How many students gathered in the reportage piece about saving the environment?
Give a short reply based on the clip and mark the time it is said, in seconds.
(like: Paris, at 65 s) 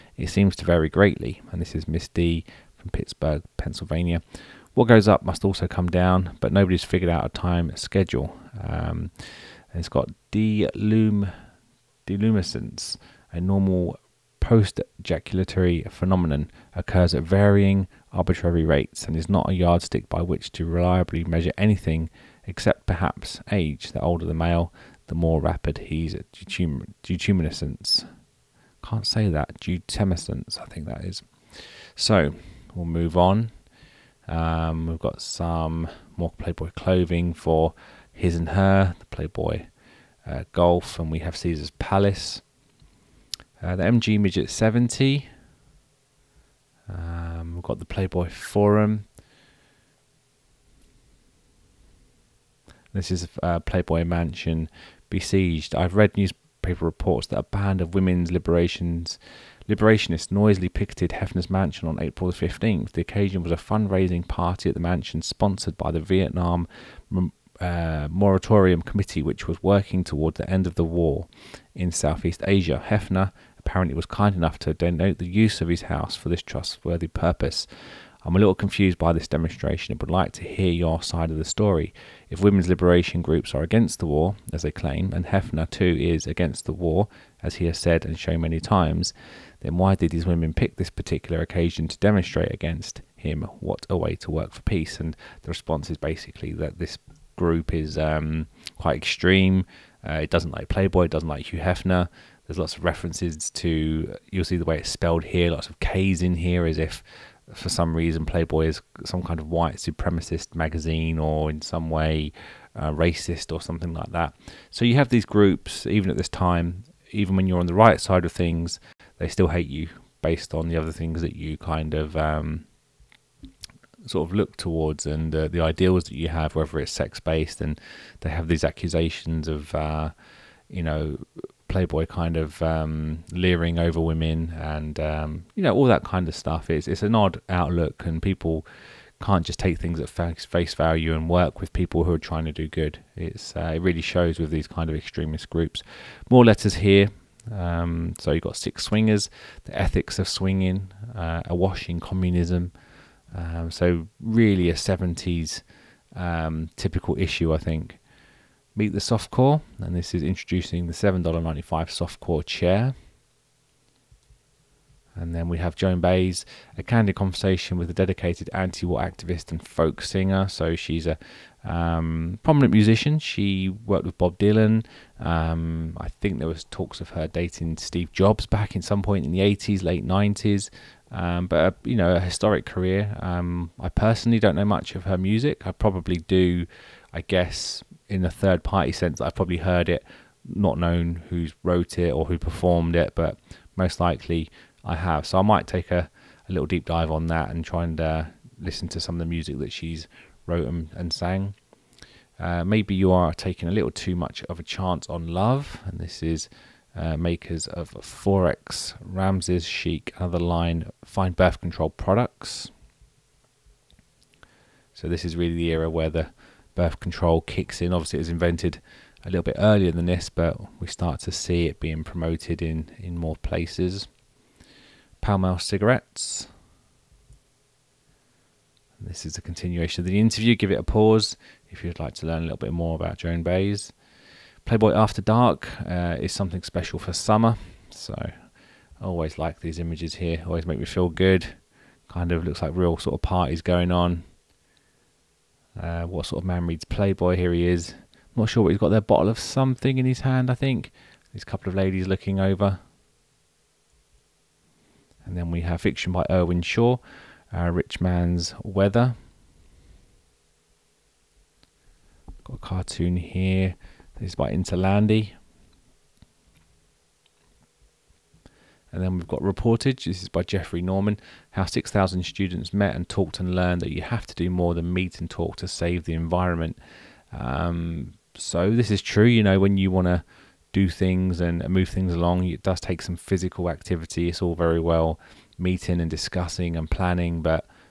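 6,000, at 271 s.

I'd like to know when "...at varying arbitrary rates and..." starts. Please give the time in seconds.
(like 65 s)
17 s.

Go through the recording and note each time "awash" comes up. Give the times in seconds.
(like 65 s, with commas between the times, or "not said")
151 s.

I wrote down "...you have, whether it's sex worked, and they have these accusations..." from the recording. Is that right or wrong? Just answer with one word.
wrong.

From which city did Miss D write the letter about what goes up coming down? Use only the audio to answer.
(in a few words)
Pittsburgh.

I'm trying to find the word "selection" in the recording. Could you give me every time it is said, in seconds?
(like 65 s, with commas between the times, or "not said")
not said.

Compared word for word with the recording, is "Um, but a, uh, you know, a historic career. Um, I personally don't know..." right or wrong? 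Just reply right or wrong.
right.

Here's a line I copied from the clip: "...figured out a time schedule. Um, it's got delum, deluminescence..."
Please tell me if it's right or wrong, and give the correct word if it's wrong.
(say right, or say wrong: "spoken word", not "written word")
right.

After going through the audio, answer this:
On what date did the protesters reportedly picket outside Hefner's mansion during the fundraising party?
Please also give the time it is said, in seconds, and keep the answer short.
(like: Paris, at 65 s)
April 15th, at 61 s.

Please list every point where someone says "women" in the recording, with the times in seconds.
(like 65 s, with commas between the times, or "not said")
57 s, 82 s, 90 s, 133 s.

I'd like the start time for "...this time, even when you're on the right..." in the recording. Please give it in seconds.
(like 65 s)
116 s.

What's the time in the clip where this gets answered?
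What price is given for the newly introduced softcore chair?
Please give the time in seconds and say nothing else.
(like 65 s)
160 s.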